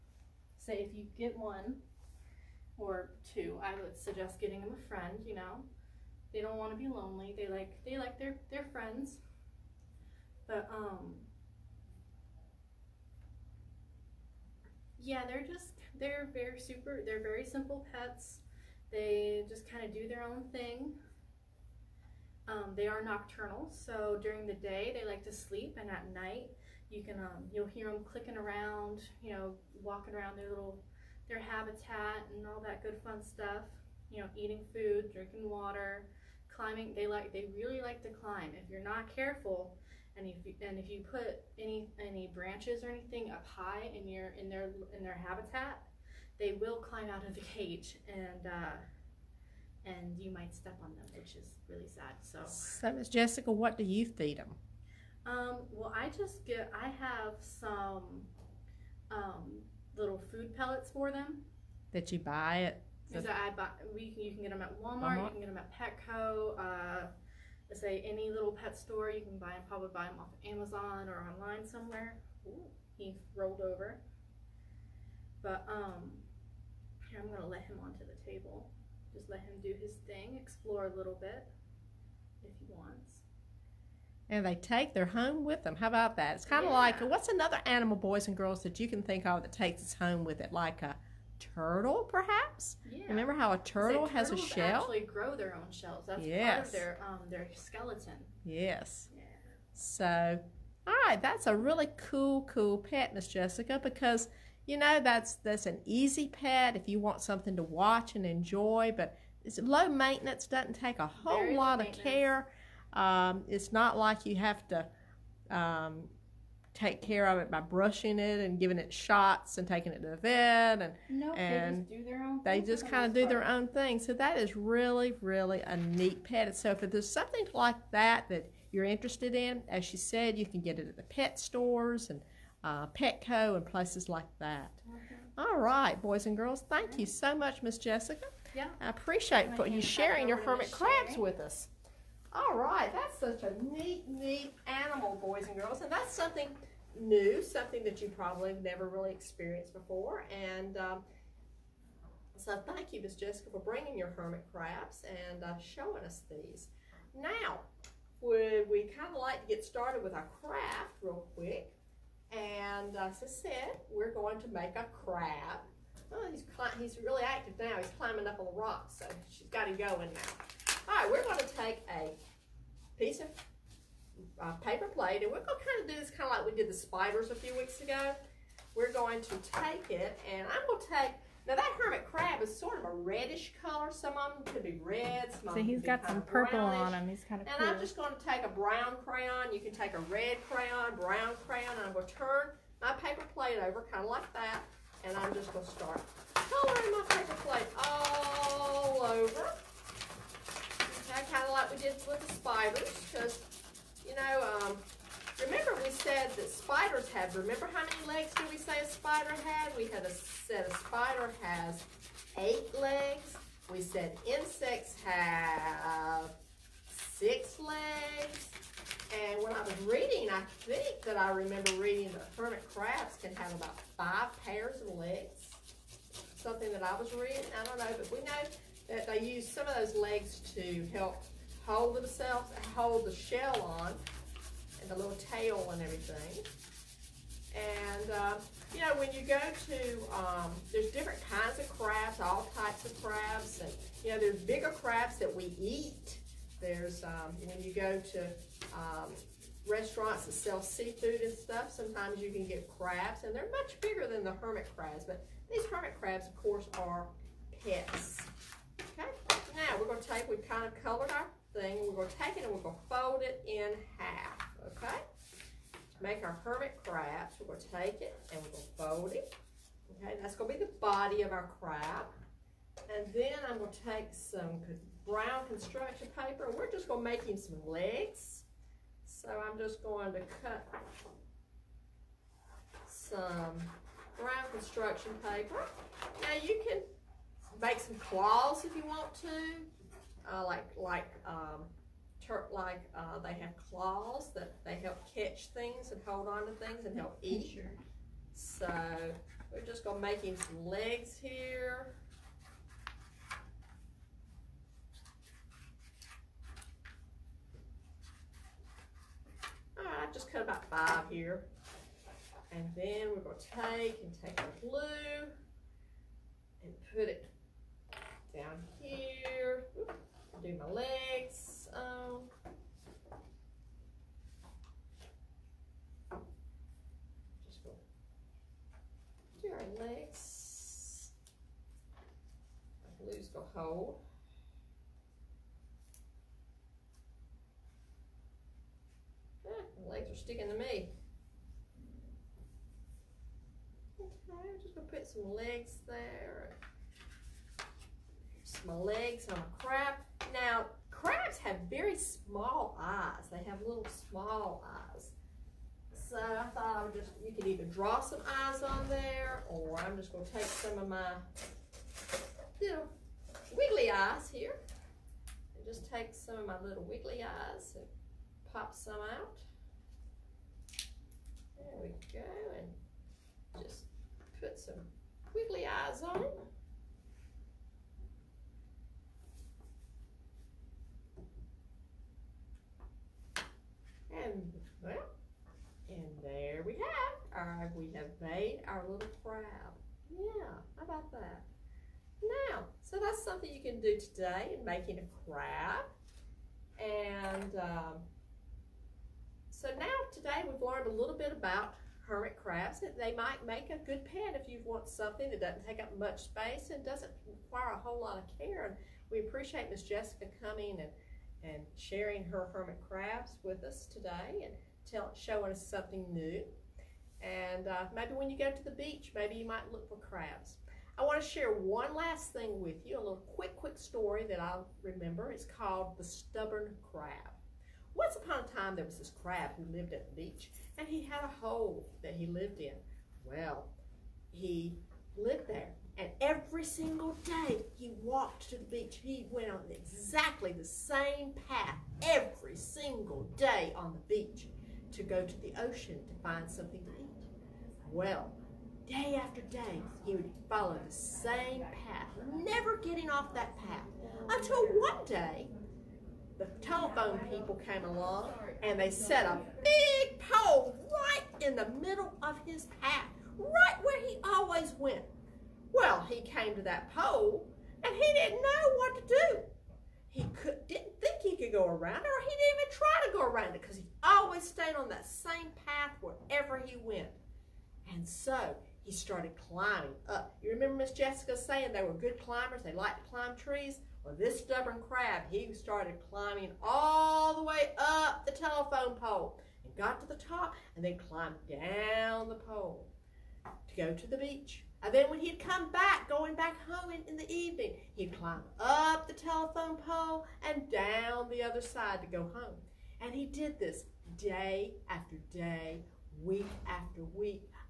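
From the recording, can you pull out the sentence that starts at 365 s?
And just take some of my little wiggly eyes and pop some out.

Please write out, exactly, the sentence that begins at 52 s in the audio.
So, so Miss Jessica, what do you feed them?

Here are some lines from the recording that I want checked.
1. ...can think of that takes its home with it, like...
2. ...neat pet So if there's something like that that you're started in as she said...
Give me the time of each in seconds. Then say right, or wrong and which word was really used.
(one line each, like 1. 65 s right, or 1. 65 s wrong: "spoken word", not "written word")
1. 88 s right
2. 125 s wrong: "interested", not "started".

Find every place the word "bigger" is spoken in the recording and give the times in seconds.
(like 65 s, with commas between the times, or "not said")
244 s, 253 s.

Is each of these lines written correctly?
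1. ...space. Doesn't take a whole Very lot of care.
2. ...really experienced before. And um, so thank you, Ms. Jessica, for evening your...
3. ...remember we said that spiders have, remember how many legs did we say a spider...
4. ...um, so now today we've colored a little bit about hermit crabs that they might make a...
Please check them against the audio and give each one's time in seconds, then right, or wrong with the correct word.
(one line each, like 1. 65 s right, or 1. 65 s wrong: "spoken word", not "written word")
1. 109 s wrong: "maintenance", not "space"
2. 148 s wrong: "bringing", not "evening"
3. 205 s right
4. 397 s wrong: "learned", not "colored".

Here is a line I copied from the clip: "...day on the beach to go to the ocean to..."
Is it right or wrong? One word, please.
right.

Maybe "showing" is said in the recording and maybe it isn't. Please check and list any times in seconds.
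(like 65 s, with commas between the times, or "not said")
155 s, 415 s.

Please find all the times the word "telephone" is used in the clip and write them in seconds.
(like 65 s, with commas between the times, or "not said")
456 s, 488 s, 499 s.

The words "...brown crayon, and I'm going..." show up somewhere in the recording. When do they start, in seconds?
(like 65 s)
190 s.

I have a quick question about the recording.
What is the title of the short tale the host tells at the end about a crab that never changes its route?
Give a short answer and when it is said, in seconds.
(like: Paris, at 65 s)
The Stubborn Crab, at 425 s.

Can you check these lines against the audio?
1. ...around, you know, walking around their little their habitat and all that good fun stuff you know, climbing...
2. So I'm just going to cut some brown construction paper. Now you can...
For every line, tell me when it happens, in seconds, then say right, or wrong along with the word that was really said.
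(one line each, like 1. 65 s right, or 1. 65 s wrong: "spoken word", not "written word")
1. 28 s wrong: "eating", not "climbing"
2. 279 s right.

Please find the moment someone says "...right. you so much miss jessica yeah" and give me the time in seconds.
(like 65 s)
136 s.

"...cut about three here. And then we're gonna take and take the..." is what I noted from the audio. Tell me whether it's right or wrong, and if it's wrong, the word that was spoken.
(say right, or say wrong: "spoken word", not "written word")
wrong: "five", not "three".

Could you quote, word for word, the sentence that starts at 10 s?
But um Yeah, they're just they're very super they're very simple pets.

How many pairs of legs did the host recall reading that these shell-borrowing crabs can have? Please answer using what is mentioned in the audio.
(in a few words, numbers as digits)
5.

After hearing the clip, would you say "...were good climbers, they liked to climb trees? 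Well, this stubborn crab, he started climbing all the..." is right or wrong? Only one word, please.
right.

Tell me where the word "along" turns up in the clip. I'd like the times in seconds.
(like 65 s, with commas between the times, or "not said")
457 s.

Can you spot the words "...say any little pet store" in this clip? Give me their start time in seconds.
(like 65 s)
67 s.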